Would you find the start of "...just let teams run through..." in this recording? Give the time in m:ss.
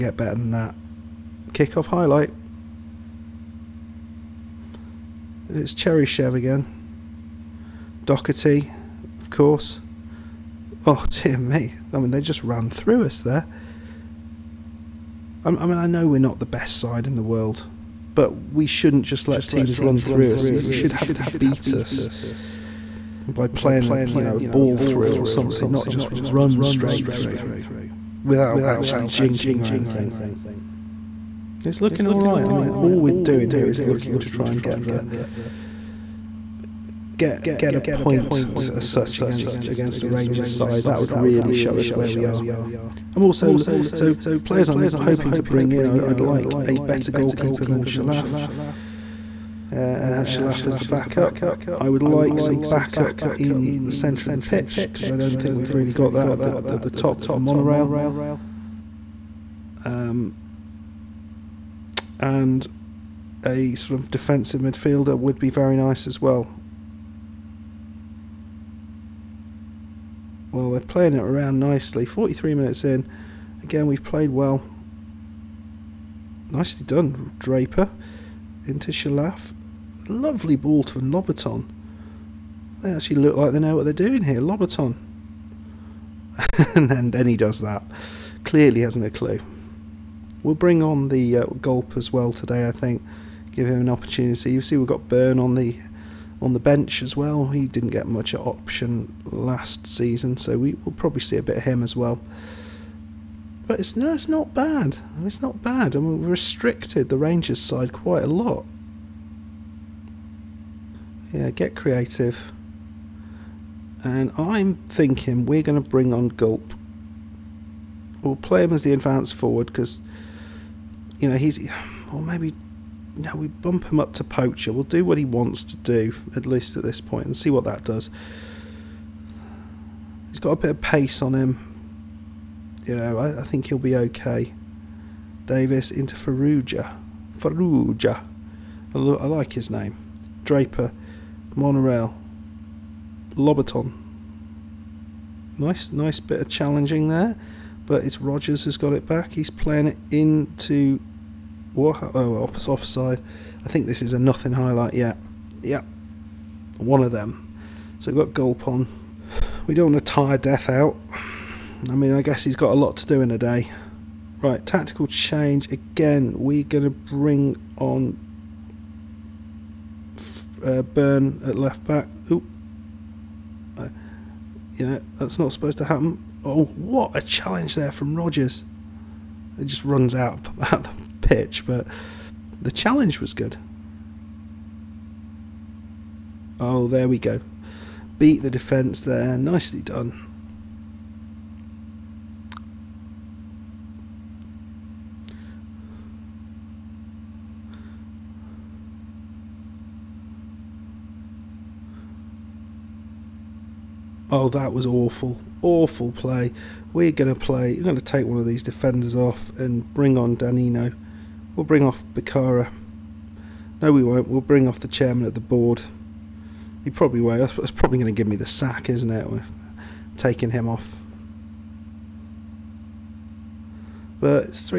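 0:19.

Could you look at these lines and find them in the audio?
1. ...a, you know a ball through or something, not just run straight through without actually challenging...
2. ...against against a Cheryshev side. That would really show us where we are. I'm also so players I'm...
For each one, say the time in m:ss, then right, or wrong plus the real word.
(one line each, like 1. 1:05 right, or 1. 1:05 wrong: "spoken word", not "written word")
1. 0:23 wrong: "jinking", not "challenging"
2. 0:39 wrong: "Rangers", not "Cheryshev".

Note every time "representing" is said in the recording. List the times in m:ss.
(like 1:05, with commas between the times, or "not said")
not said.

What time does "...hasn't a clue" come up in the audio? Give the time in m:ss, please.
1:28.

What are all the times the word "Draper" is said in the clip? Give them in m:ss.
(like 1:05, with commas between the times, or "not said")
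1:17, 2:20.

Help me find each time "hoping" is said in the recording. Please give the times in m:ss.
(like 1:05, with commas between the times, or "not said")
0:44.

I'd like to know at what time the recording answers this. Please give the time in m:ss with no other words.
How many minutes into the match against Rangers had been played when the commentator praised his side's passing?
1:12.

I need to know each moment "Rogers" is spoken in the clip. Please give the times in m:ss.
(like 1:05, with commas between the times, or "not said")
2:28, 2:58.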